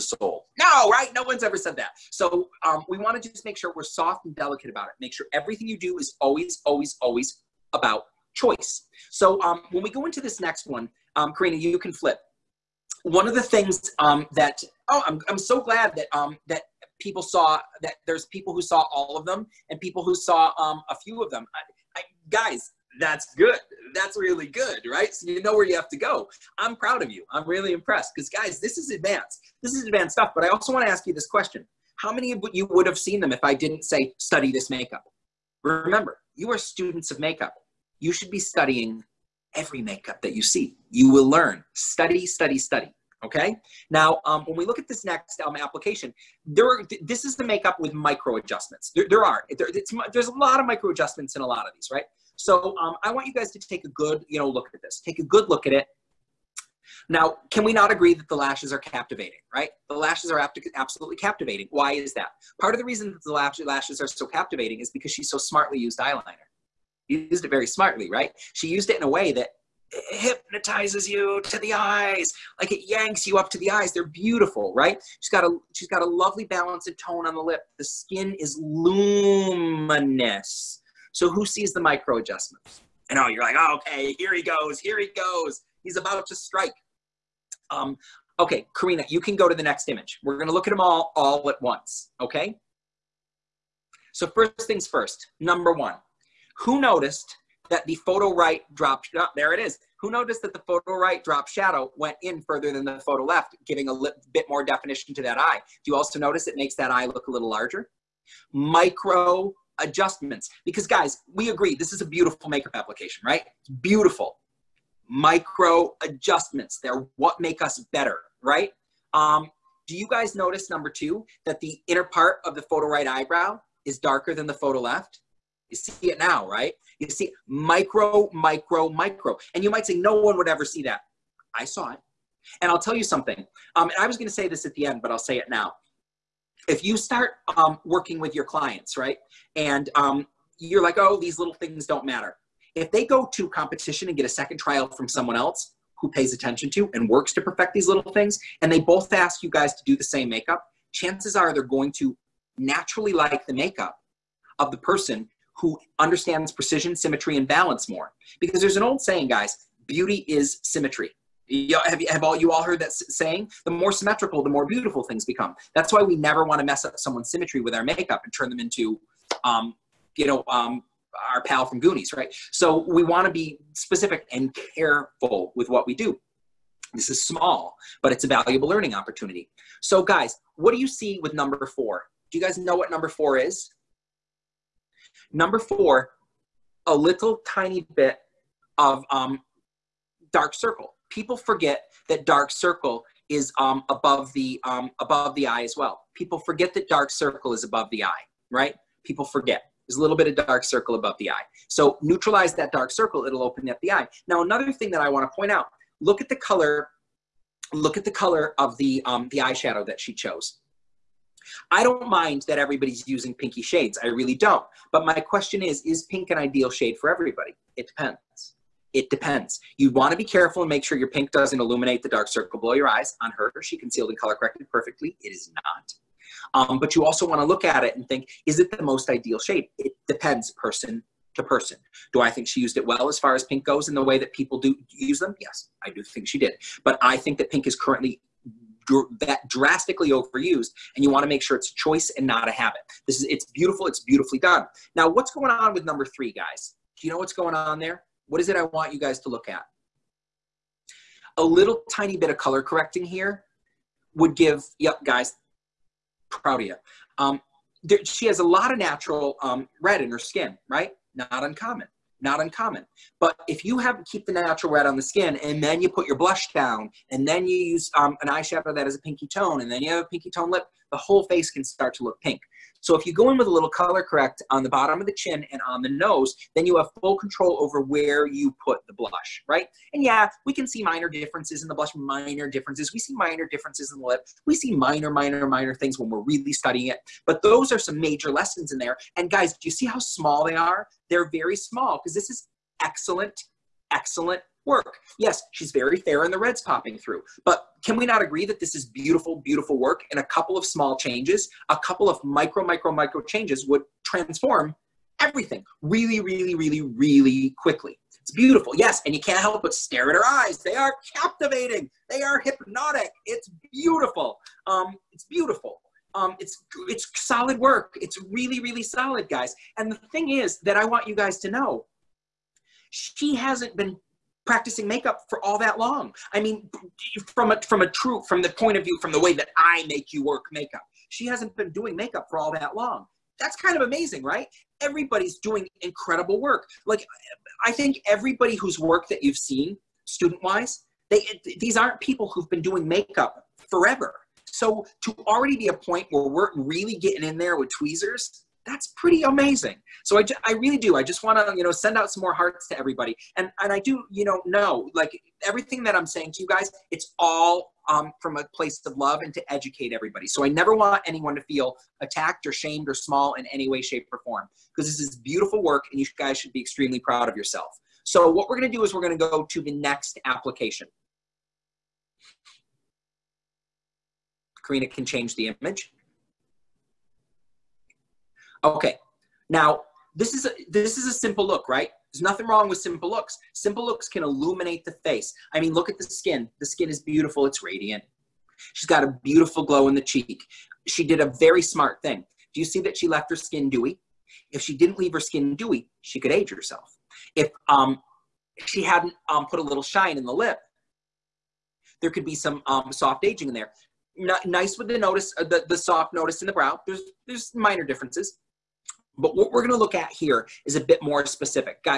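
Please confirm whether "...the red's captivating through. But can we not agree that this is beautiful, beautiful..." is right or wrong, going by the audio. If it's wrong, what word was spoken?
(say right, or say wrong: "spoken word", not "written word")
wrong: "popping", not "captivating".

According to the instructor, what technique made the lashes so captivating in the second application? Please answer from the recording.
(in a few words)
eyeliner.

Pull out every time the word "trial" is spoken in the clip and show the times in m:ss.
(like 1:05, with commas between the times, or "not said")
2:24.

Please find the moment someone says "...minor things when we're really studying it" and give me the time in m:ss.
4:45.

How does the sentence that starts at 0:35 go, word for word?
Remember, you are students of makeup.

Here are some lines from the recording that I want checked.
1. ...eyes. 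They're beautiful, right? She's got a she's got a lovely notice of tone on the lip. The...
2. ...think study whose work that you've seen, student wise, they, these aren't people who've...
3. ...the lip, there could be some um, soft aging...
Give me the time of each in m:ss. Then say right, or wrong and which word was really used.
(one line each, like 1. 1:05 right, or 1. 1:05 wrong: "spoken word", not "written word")
1. 1:13 wrong: "balance", not "notice"
2. 5:37 wrong: "everybody", not "study"
3. 6:40 right.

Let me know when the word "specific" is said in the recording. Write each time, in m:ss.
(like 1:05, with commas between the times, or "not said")
2:53, 6:51.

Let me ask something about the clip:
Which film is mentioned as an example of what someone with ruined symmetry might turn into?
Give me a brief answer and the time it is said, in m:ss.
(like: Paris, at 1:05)
Goonies, at 2:51.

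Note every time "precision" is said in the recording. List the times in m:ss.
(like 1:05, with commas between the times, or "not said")
2:36.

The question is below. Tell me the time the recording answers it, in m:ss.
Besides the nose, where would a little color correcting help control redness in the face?
4:34.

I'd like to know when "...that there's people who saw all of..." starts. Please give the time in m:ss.
0:17.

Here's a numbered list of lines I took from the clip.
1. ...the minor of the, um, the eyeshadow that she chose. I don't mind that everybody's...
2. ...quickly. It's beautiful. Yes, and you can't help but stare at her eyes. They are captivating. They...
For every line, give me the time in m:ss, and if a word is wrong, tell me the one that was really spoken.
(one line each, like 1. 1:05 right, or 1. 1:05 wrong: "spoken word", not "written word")
1. 3:28 wrong: "color", not "minor"
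2. 5:07 right.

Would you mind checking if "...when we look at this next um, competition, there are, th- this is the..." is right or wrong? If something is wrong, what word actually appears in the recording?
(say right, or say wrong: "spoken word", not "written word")
wrong: "application", not "competition".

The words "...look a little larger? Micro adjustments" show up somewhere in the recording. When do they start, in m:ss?
1:47.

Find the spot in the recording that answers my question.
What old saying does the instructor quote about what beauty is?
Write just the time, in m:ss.
2:39.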